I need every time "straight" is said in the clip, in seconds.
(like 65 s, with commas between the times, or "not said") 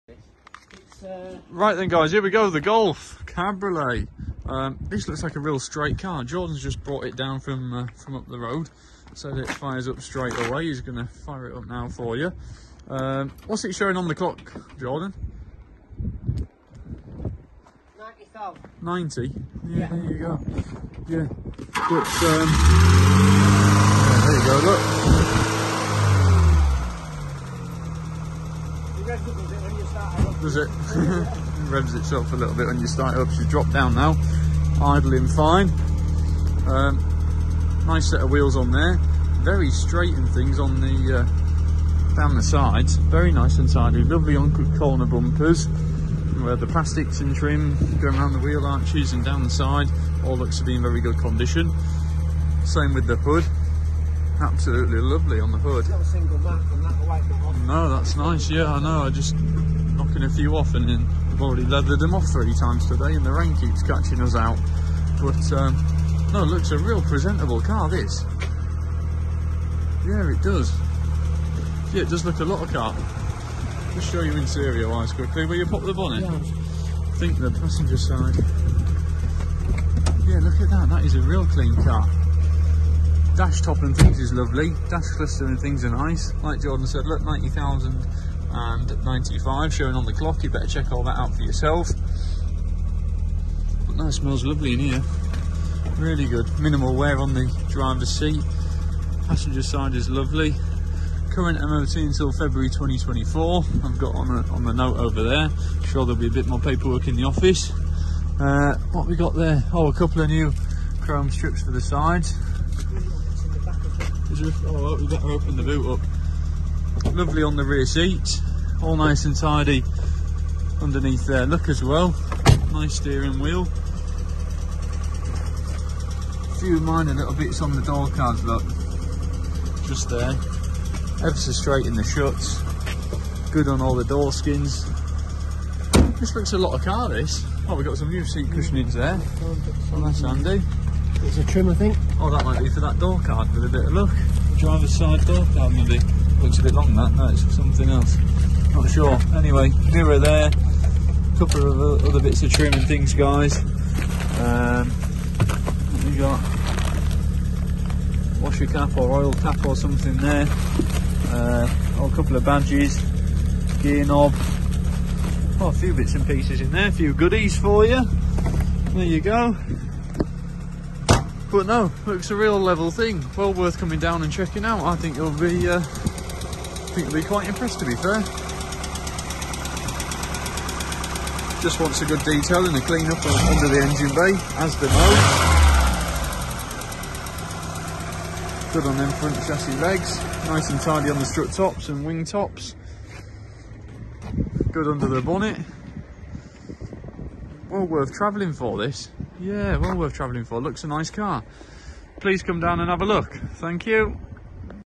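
5 s, 10 s, 39 s, 131 s.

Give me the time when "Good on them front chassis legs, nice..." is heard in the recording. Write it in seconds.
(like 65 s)
188 s.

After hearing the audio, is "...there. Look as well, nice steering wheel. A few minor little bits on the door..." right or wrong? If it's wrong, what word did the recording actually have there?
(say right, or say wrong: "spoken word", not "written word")
right.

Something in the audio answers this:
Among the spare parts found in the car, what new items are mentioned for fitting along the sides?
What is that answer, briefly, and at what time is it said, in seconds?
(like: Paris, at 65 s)
chrome strips, at 110 s.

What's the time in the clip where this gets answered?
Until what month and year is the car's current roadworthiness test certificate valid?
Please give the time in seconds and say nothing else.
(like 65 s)
102 s.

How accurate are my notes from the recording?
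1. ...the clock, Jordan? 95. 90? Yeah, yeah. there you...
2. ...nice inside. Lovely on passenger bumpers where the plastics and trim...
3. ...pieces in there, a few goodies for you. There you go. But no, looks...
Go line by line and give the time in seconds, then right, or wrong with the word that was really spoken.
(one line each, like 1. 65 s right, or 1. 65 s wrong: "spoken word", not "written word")
1. 14 s right
2. 43 s wrong: "corner", not "passenger"
3. 166 s right.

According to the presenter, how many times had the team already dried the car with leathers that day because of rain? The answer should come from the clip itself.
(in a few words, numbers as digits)
3.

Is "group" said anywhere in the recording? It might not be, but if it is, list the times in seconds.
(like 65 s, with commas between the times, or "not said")
not said.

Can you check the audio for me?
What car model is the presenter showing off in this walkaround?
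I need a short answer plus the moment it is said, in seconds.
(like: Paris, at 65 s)
Golf Cabriolet, at 2 s.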